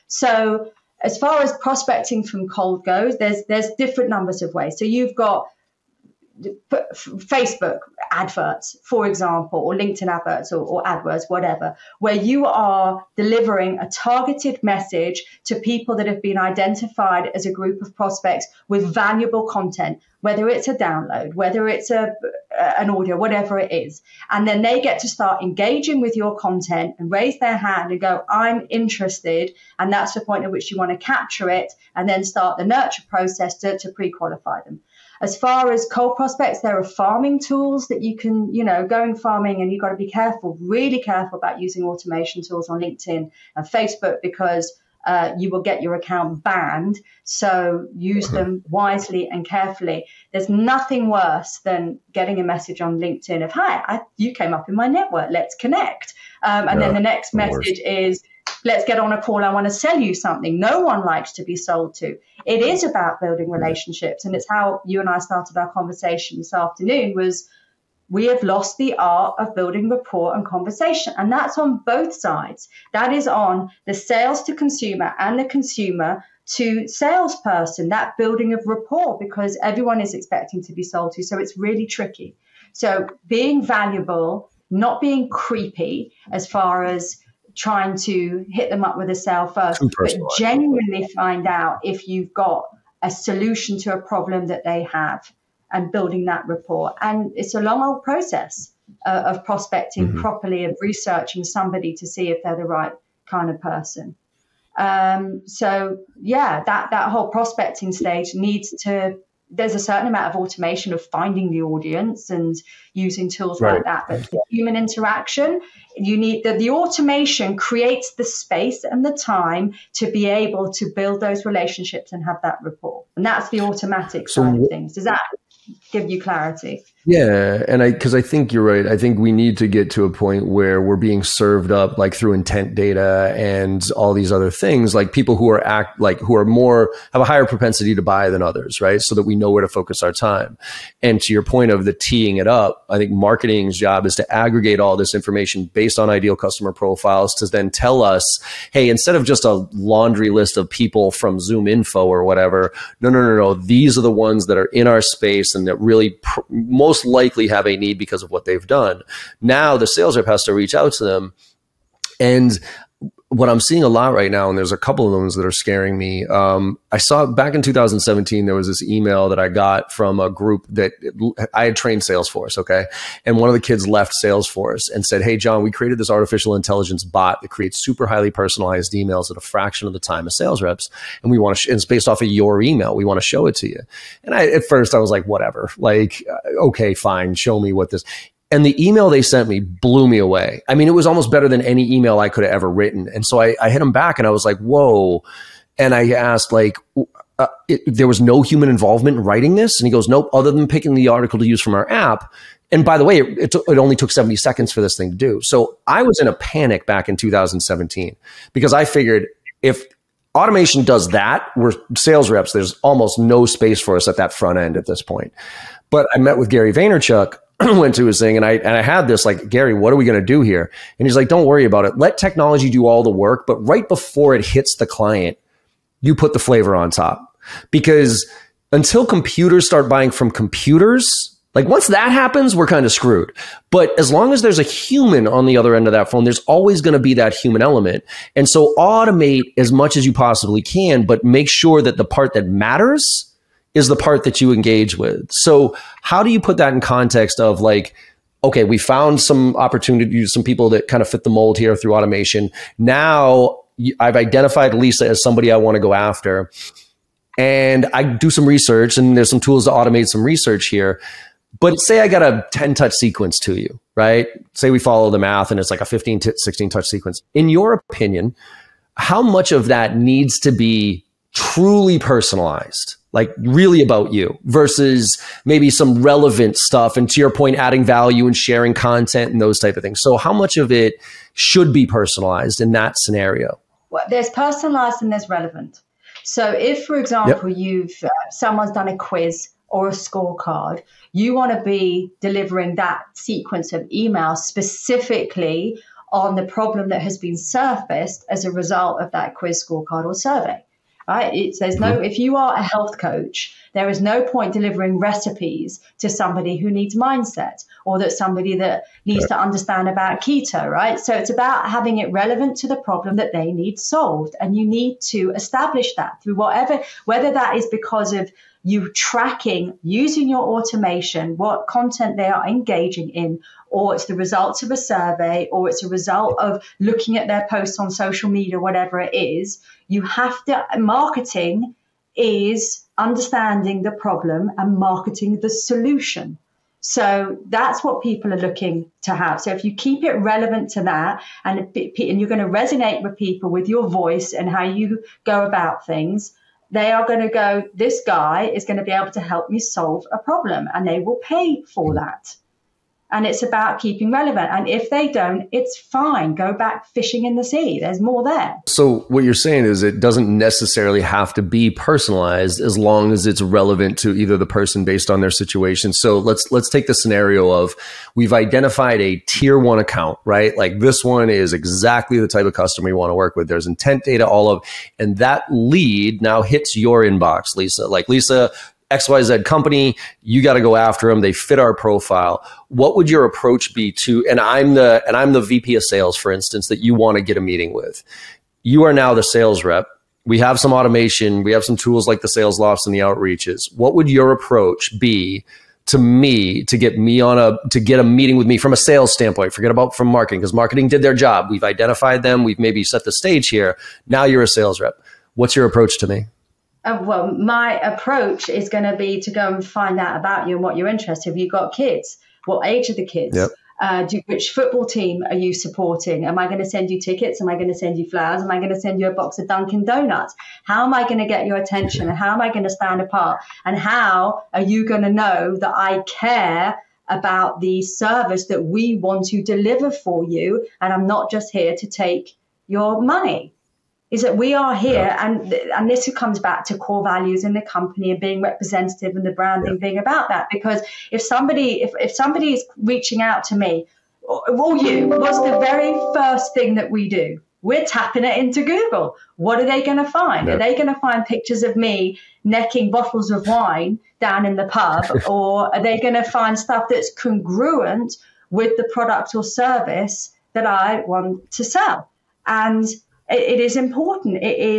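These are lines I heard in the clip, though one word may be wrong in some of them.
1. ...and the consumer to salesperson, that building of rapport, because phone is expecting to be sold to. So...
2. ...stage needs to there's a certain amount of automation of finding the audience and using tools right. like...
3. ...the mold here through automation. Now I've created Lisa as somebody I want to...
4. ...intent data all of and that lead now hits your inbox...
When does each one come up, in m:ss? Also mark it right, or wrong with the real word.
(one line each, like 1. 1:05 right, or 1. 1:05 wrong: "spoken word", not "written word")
1. 1:15 wrong: "everyone", not "phone"
2. 1:47 right
3. 4:11 wrong: "identified", not "created"
4. 6:13 right.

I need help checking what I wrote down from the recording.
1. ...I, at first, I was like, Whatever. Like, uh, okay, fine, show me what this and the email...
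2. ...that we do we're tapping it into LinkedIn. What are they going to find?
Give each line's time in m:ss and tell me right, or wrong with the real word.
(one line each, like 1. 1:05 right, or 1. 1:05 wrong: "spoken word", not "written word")
1. 3:04 right
2. 7:26 wrong: "Google", not "LinkedIn".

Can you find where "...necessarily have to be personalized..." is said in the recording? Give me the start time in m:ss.
6:00.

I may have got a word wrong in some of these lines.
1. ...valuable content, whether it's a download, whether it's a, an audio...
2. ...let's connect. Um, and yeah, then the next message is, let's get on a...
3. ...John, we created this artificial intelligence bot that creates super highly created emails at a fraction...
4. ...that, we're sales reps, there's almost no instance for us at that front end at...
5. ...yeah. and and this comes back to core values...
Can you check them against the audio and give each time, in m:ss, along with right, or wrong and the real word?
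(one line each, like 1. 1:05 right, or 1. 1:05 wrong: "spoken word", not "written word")
1. 0:18 right
2. 0:55 right
3. 2:55 wrong: "personalized", not "created"
4. 3:31 wrong: "space", not "instance"
5. 7:15 right.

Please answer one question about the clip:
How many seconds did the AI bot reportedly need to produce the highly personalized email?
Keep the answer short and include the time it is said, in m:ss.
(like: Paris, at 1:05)
70, at 3:24.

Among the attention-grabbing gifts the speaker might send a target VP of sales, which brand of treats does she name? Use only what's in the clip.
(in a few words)
Dunkin' Donuts.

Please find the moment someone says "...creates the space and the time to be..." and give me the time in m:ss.
1:57.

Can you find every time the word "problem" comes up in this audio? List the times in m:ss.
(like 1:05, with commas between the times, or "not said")
1:34, 4:56, 5:12, 5:33, 5:50.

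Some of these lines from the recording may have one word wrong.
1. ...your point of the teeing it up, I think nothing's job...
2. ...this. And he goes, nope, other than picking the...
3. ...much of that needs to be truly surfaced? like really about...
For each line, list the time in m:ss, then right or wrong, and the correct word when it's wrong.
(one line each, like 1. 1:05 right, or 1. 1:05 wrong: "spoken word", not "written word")
1. 2:21 wrong: "marketing", not "nothing"
2. 3:19 right
3. 4:29 wrong: "personalized", not "surfaced".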